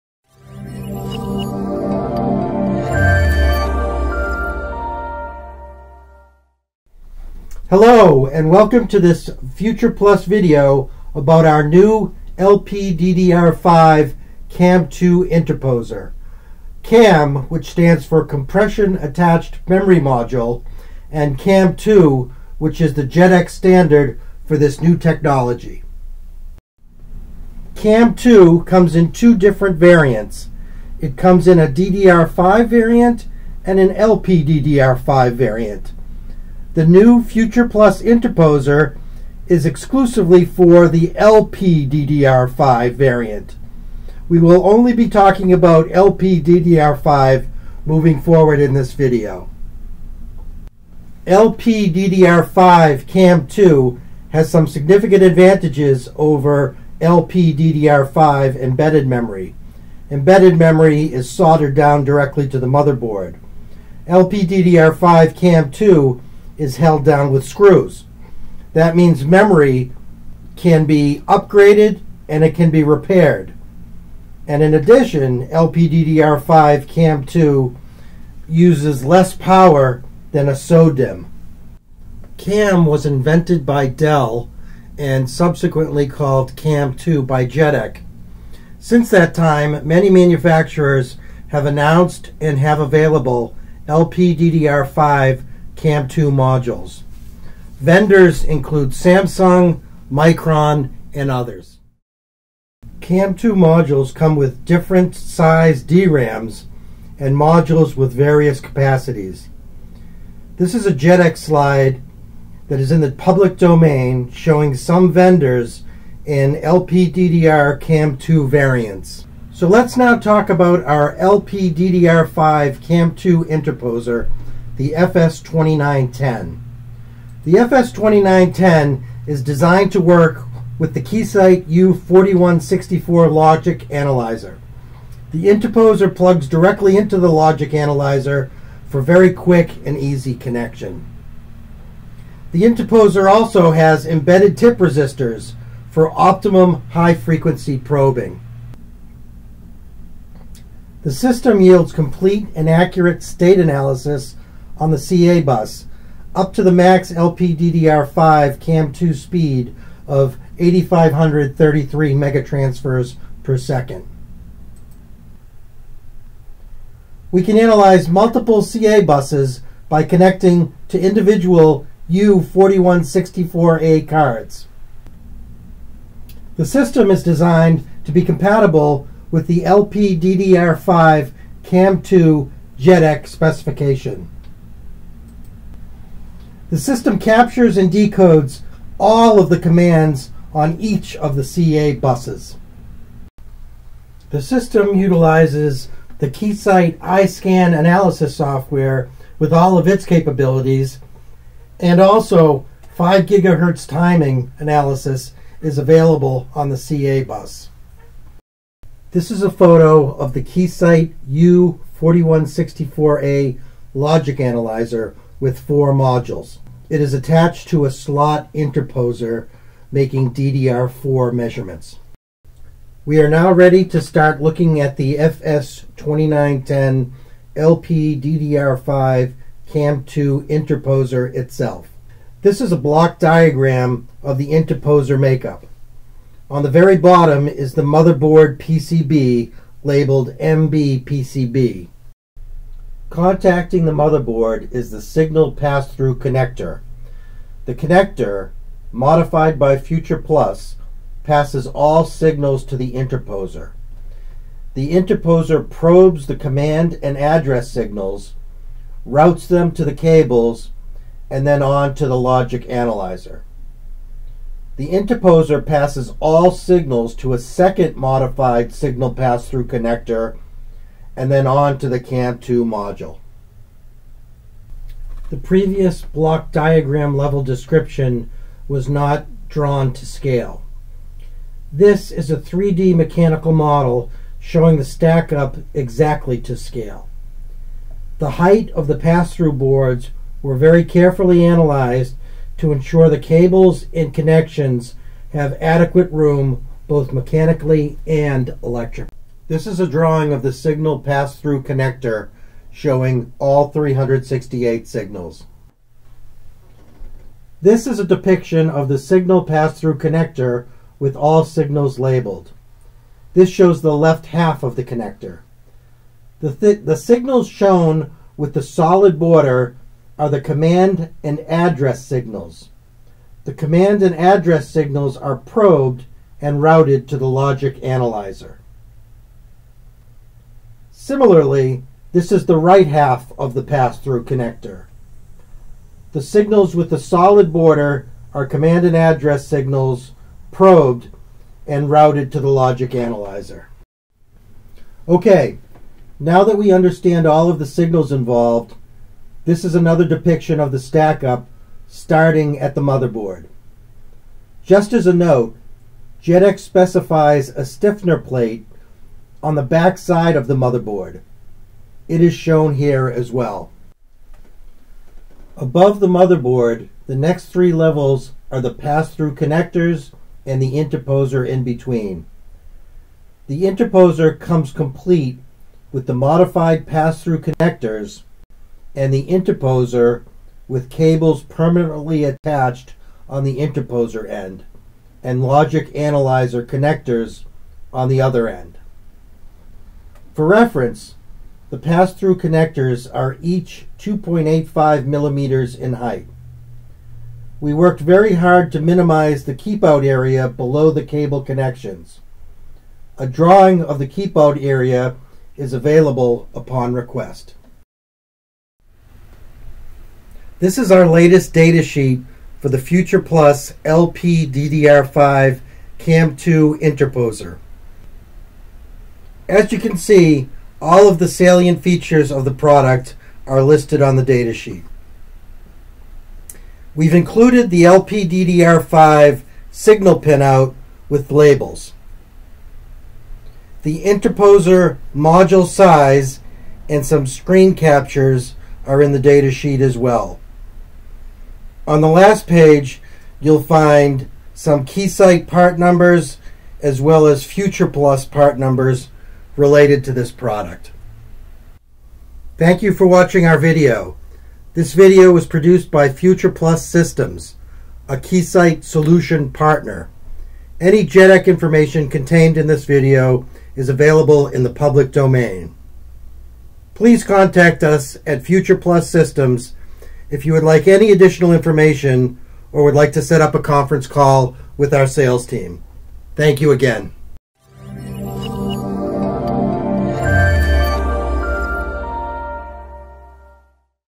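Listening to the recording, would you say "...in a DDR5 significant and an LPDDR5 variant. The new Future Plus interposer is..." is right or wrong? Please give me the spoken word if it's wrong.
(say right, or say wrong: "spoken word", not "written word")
wrong: "variant", not "significant".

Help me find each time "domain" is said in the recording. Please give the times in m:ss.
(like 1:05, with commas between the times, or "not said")
1:53, 7:45.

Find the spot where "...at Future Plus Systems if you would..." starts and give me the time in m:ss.
7:48.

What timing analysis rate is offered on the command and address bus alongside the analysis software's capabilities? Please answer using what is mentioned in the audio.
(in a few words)
5 gigahertz.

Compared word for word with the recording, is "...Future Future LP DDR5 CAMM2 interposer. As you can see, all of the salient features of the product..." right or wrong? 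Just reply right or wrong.
wrong.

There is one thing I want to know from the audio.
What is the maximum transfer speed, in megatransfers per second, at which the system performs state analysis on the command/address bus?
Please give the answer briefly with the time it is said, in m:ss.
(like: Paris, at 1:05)
8,533, at 2:40.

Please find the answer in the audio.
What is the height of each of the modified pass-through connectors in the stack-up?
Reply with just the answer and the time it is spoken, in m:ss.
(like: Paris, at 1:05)
2.85 millimeters, at 6:33.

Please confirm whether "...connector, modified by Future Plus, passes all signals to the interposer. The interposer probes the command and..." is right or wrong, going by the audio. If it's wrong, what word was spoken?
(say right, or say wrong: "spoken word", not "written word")
right.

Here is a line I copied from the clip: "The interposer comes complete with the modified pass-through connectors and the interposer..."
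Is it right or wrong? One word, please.
right.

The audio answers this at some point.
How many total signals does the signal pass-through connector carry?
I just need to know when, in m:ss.
5:03.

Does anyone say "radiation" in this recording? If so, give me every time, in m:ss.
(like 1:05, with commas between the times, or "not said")
not said.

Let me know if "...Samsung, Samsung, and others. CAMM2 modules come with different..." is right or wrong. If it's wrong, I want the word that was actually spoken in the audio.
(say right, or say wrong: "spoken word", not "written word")
wrong: "Micron", not "Samsung".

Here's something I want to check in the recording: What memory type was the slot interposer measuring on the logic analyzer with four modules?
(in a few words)
DDR4.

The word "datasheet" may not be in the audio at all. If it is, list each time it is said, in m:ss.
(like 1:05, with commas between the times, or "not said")
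6:51, 7:04, 7:19.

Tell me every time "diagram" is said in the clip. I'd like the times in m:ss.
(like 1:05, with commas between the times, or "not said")
3:53, 4:36.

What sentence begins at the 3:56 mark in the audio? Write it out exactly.
On the very bottom is the motherboard PCB labeled MB PCB.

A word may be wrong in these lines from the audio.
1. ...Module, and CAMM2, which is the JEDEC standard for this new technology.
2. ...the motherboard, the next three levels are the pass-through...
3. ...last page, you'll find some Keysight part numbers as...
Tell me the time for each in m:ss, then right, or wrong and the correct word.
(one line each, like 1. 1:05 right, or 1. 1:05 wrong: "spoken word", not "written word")
1. 0:20 right
2. 6:05 right
3. 7:22 right.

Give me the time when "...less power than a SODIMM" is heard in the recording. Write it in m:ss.
1:19.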